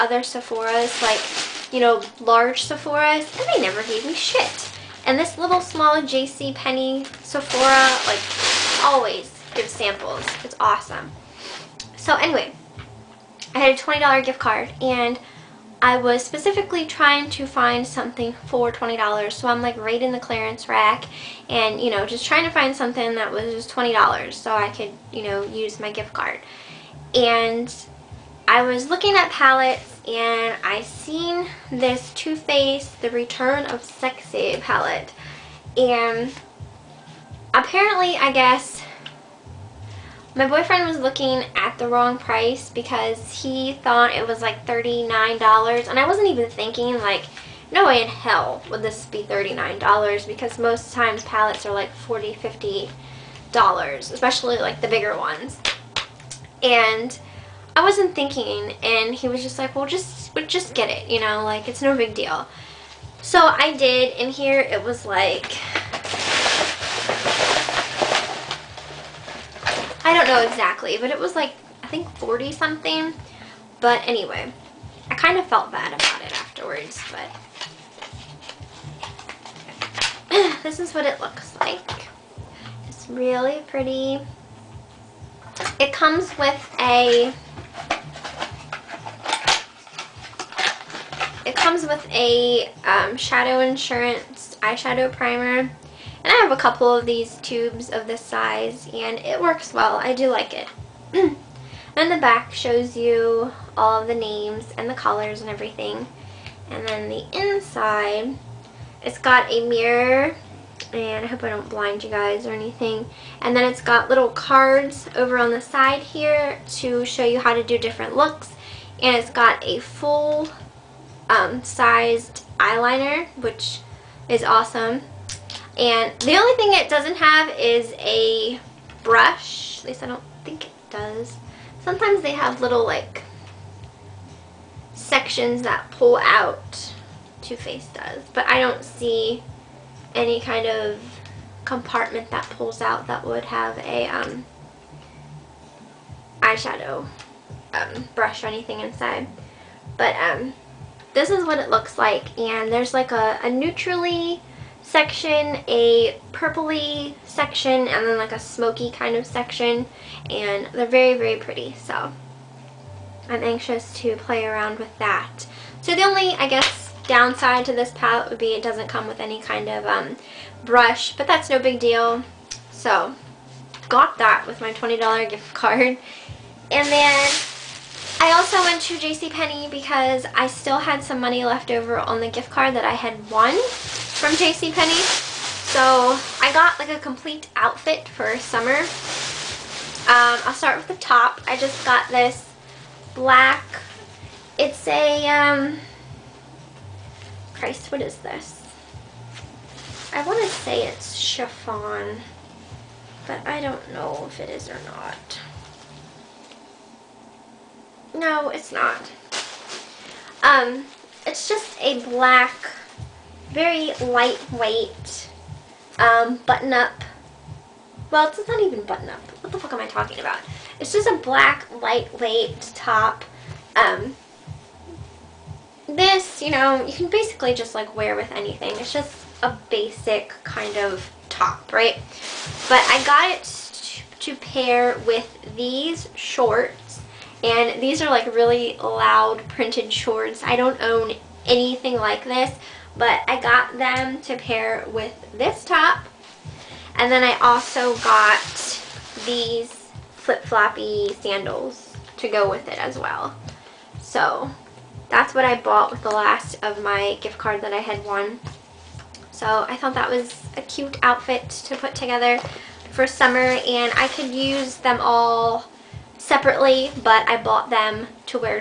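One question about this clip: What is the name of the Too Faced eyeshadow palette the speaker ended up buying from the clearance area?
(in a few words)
The Return of Sexy.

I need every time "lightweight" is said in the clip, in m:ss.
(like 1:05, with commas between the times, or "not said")
3:34, 3:41.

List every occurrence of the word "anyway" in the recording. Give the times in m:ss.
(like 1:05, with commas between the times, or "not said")
0:12, 1:14.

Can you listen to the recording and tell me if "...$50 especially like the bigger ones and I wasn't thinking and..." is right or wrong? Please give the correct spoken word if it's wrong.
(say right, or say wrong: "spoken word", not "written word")
right.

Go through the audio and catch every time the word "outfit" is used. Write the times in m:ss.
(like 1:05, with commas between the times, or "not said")
3:07, 4:21.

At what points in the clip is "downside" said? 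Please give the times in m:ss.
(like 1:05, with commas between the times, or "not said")
2:47.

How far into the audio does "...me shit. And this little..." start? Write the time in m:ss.
0:04.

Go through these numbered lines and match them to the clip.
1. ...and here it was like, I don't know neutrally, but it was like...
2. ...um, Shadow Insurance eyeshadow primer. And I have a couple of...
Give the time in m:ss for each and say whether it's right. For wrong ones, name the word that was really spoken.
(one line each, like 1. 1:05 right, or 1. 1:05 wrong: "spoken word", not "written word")
1. 1:04 wrong: "exactly", not "neutrally"
2. 1:32 right.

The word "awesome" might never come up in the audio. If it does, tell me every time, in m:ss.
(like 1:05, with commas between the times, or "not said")
0:10, 2:04.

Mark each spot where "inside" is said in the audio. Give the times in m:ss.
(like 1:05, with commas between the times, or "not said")
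1:47, 2:28.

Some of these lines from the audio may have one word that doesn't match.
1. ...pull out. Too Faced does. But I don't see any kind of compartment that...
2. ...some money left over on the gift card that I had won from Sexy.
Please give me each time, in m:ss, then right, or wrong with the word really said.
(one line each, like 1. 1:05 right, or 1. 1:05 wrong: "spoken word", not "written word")
1. 2:15 right
2. 3:01 wrong: "JCPenney", not "Sexy".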